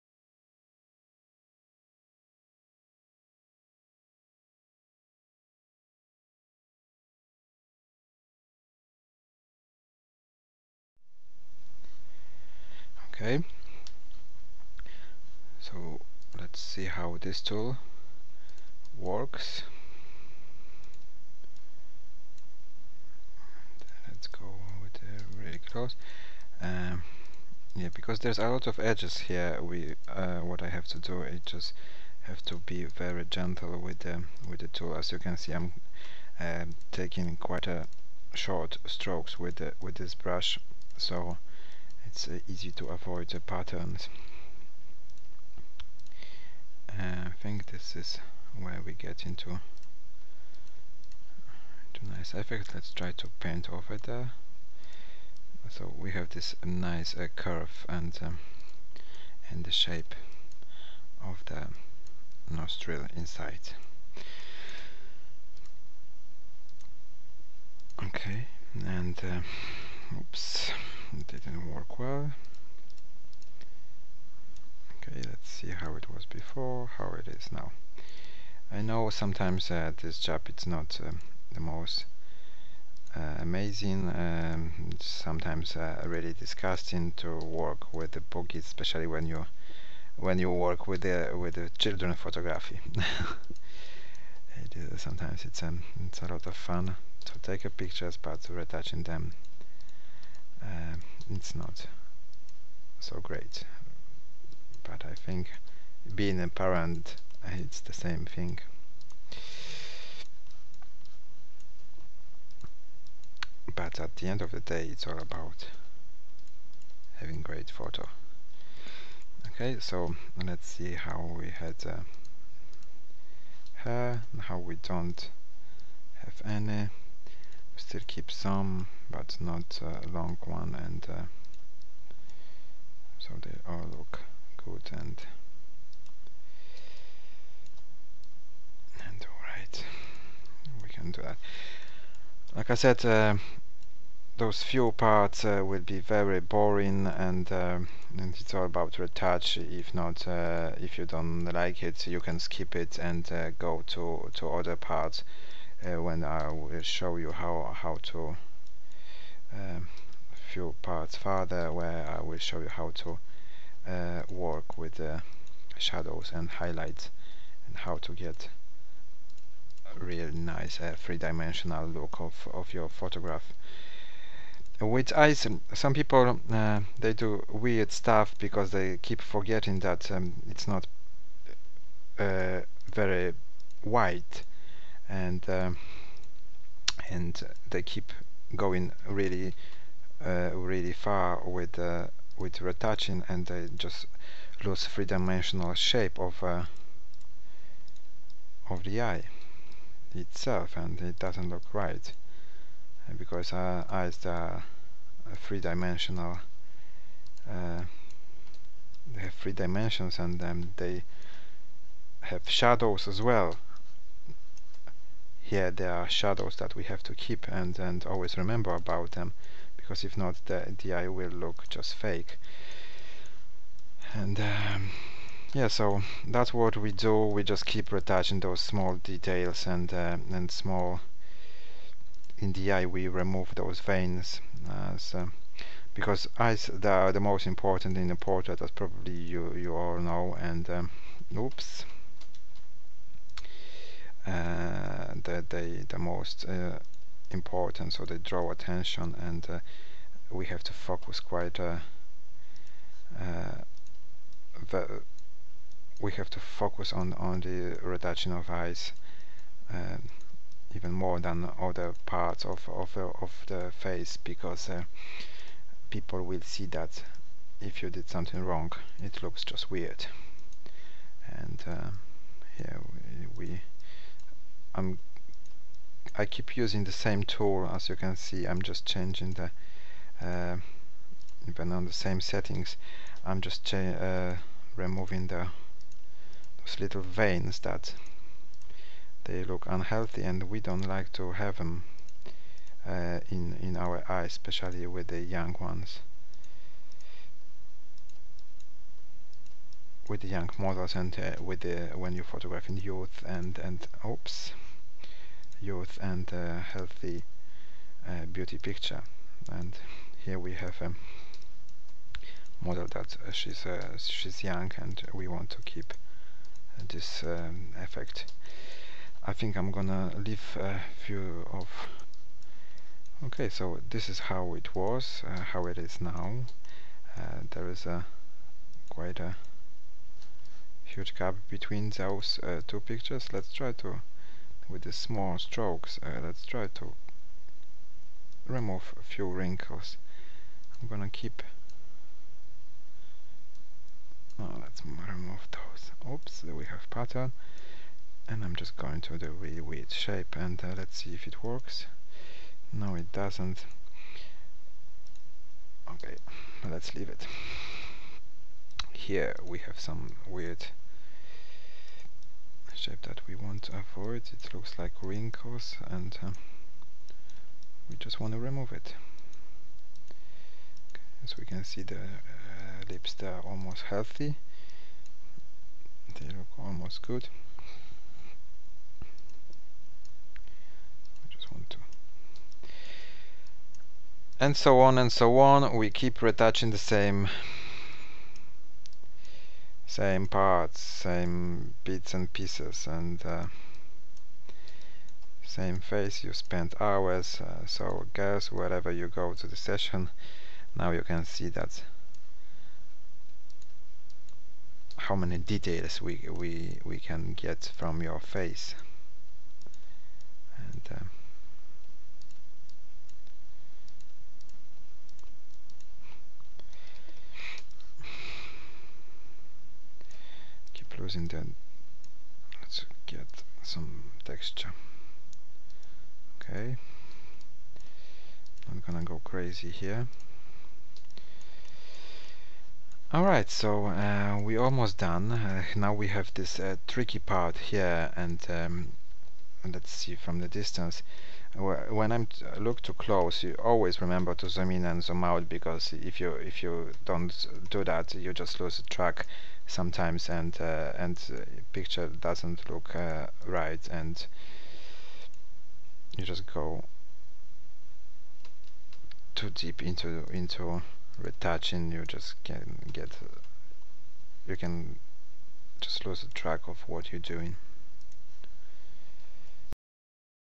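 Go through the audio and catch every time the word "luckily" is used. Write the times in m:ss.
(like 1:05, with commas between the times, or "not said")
not said.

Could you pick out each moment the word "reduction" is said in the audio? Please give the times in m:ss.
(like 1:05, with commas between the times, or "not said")
4:17.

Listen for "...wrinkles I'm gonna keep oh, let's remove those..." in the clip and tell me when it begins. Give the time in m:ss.
5:39.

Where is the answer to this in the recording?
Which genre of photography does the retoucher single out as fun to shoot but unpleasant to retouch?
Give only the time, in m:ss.
1:31.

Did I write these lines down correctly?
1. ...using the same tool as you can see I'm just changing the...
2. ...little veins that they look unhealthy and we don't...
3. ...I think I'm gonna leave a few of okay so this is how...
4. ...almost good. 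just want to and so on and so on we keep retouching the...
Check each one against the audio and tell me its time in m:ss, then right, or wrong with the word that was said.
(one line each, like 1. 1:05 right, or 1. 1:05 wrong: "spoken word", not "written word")
1. 4:36 right
2. 4:46 right
3. 5:19 right
4. 6:16 right.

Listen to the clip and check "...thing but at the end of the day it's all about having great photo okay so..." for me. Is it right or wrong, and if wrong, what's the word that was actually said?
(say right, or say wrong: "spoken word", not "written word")
right.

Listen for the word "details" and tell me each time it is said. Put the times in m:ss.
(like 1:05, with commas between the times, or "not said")
3:49, 6:45.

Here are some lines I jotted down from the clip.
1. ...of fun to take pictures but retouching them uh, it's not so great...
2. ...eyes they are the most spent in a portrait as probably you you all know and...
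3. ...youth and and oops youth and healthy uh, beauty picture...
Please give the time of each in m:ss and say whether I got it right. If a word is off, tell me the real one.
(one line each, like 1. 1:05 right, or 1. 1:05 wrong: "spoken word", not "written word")
1. 1:36 right
2. 3:56 wrong: "important", not "spent"
3. 5:02 right.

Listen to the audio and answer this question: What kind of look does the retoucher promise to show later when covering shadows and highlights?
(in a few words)
three-dimensional look.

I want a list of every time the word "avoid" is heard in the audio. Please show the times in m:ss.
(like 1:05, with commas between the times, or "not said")
0:42, 6:03.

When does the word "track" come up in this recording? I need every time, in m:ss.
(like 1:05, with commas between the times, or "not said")
7:28, 7:46.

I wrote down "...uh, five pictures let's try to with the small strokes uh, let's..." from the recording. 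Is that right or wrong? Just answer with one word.
wrong.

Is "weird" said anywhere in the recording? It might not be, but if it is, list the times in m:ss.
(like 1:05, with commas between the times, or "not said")
2:57, 4:29, 5:49, 6:00.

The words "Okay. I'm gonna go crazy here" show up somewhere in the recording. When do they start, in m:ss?
7:06.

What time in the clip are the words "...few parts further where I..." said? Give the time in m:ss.
2:40.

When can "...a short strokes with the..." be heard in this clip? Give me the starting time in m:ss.
0:37.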